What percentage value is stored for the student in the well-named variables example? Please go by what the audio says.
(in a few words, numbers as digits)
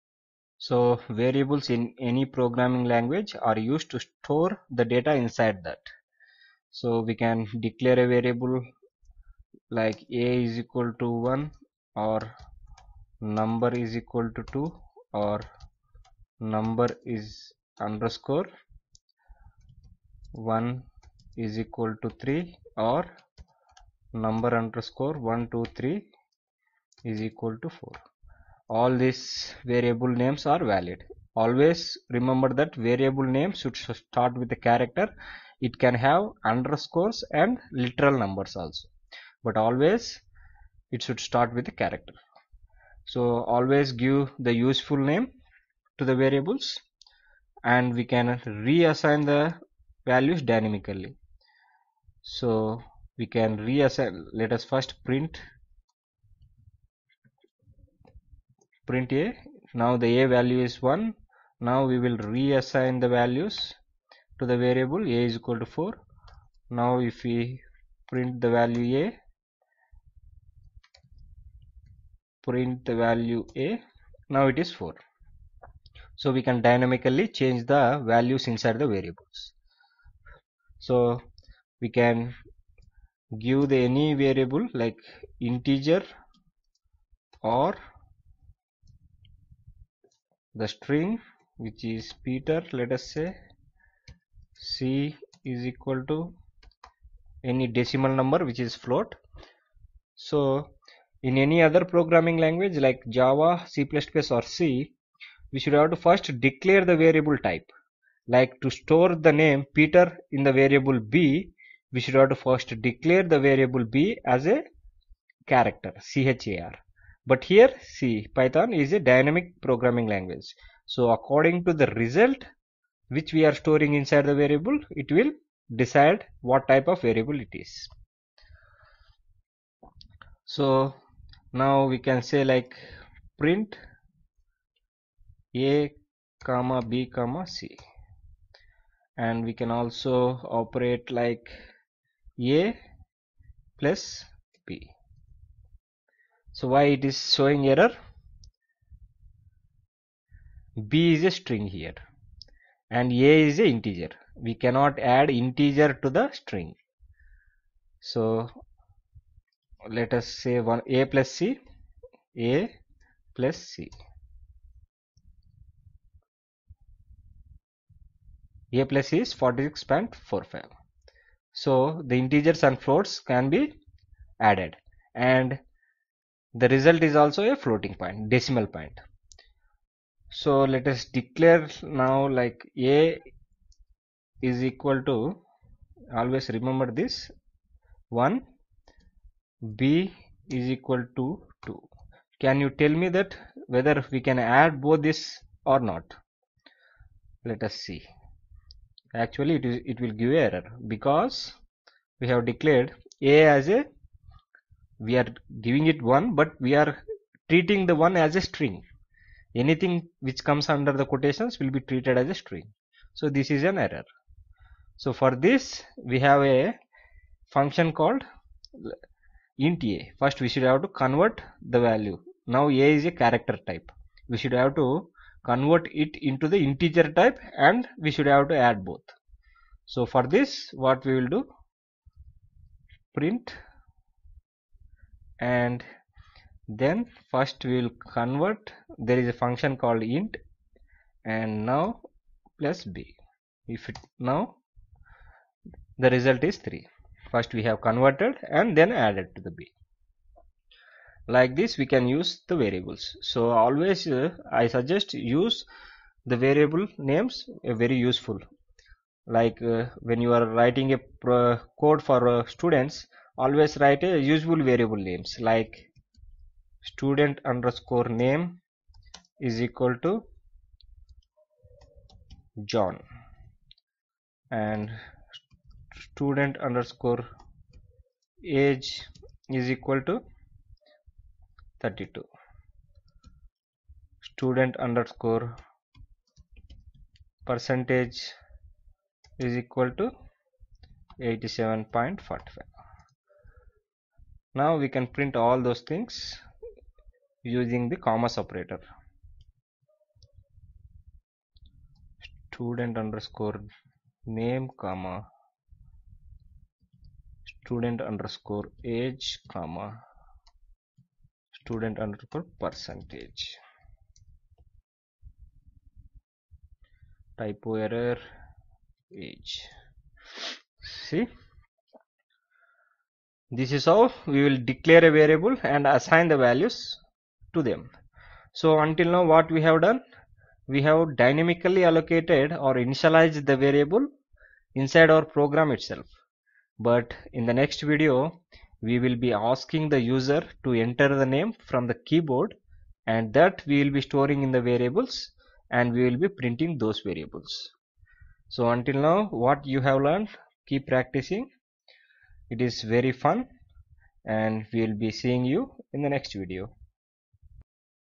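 87.45.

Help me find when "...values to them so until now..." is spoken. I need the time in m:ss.
5:26.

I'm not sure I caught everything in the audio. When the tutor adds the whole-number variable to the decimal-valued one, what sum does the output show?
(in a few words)
46.45.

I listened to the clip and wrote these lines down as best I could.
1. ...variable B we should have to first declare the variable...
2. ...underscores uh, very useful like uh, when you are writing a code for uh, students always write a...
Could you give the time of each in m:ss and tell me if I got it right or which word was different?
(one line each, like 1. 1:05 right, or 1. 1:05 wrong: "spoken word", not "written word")
1. 1:50 right
2. 4:17 wrong: "names", not "underscores".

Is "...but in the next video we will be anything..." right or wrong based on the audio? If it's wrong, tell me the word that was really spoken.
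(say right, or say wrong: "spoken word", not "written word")
wrong: "asking", not "anything".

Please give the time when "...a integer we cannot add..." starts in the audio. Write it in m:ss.
2:33.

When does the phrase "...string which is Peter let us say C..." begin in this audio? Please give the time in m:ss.
1:30.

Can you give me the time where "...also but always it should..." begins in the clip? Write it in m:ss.
0:38.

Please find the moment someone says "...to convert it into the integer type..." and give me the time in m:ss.
3:44.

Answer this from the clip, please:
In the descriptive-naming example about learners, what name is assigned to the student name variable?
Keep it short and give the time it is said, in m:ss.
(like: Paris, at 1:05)
John, at 4:32.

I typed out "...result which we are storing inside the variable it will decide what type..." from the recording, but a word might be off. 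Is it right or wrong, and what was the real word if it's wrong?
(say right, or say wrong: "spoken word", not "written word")
right.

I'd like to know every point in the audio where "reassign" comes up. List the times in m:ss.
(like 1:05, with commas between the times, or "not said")
0:48, 0:53, 1:02.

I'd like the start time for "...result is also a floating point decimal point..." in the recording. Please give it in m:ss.
2:56.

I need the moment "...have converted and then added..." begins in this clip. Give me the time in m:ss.
4:07.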